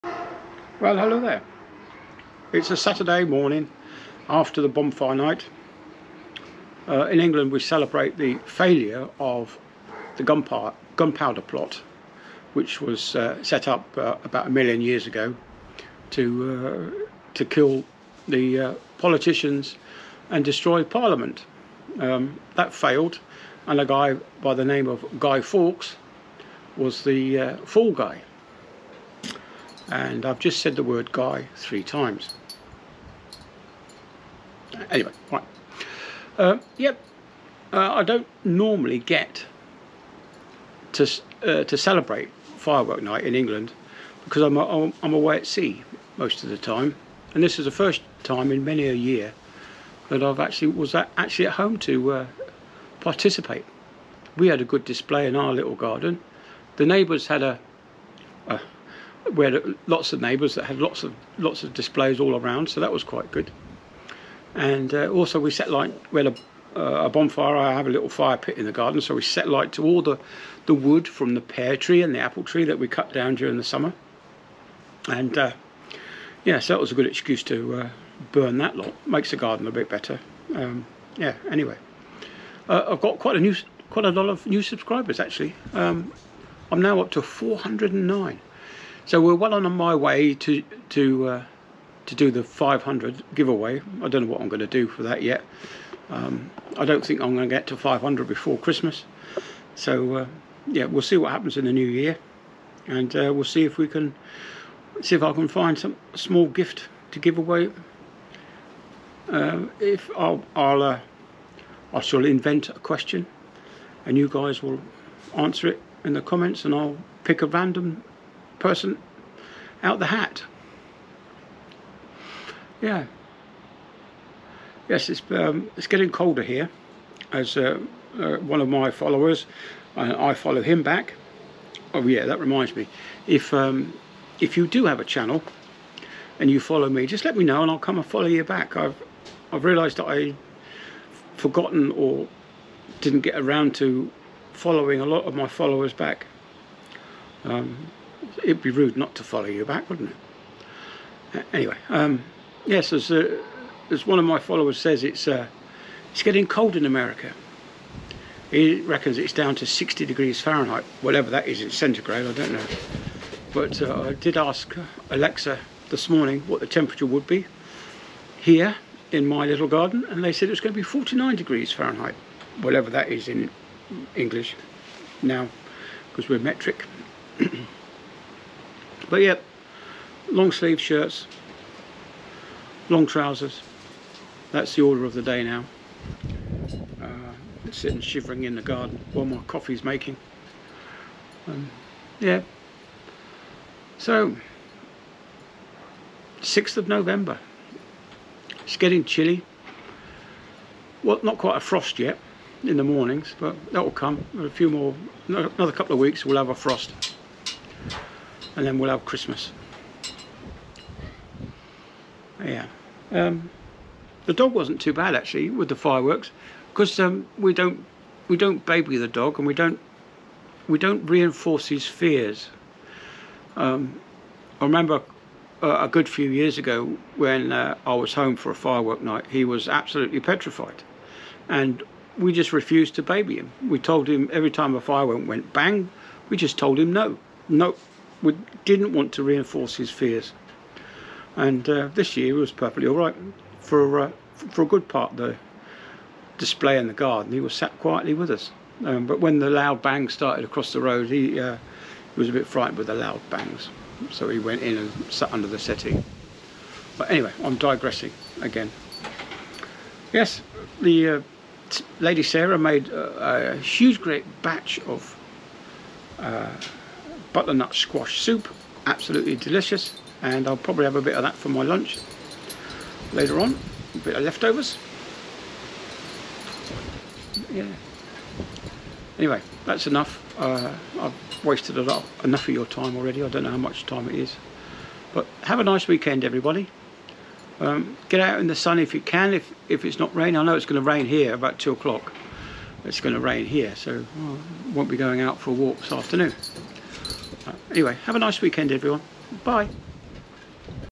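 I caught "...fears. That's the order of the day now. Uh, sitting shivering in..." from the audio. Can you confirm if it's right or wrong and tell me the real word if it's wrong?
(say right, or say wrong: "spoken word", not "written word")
wrong: "trousers", not "fears".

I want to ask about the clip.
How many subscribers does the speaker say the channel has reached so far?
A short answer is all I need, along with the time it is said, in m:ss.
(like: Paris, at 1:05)
409, at 1:27.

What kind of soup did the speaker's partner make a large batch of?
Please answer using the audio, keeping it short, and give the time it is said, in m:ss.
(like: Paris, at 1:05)
butternut squash soup, at 4:27.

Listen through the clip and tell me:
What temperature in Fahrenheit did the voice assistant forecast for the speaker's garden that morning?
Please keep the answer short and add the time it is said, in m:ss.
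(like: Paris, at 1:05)
49 degrees Fahrenheit, at 2:50.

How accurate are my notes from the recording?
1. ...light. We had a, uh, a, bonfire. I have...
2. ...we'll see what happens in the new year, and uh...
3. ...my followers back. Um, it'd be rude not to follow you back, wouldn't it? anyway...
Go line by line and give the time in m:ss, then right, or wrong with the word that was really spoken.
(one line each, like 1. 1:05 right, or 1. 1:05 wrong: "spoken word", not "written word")
1. 1:05 right
2. 1:40 right
3. 2:25 right.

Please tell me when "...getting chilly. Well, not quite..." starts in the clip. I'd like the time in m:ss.
3:18.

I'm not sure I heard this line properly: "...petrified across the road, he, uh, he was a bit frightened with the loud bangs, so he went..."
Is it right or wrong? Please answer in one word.
wrong.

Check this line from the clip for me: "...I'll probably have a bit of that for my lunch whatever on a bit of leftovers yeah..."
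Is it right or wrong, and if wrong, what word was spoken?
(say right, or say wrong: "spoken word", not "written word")
wrong: "later", not "whatever".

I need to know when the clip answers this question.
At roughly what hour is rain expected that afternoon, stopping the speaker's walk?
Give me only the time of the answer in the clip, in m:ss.
4:51.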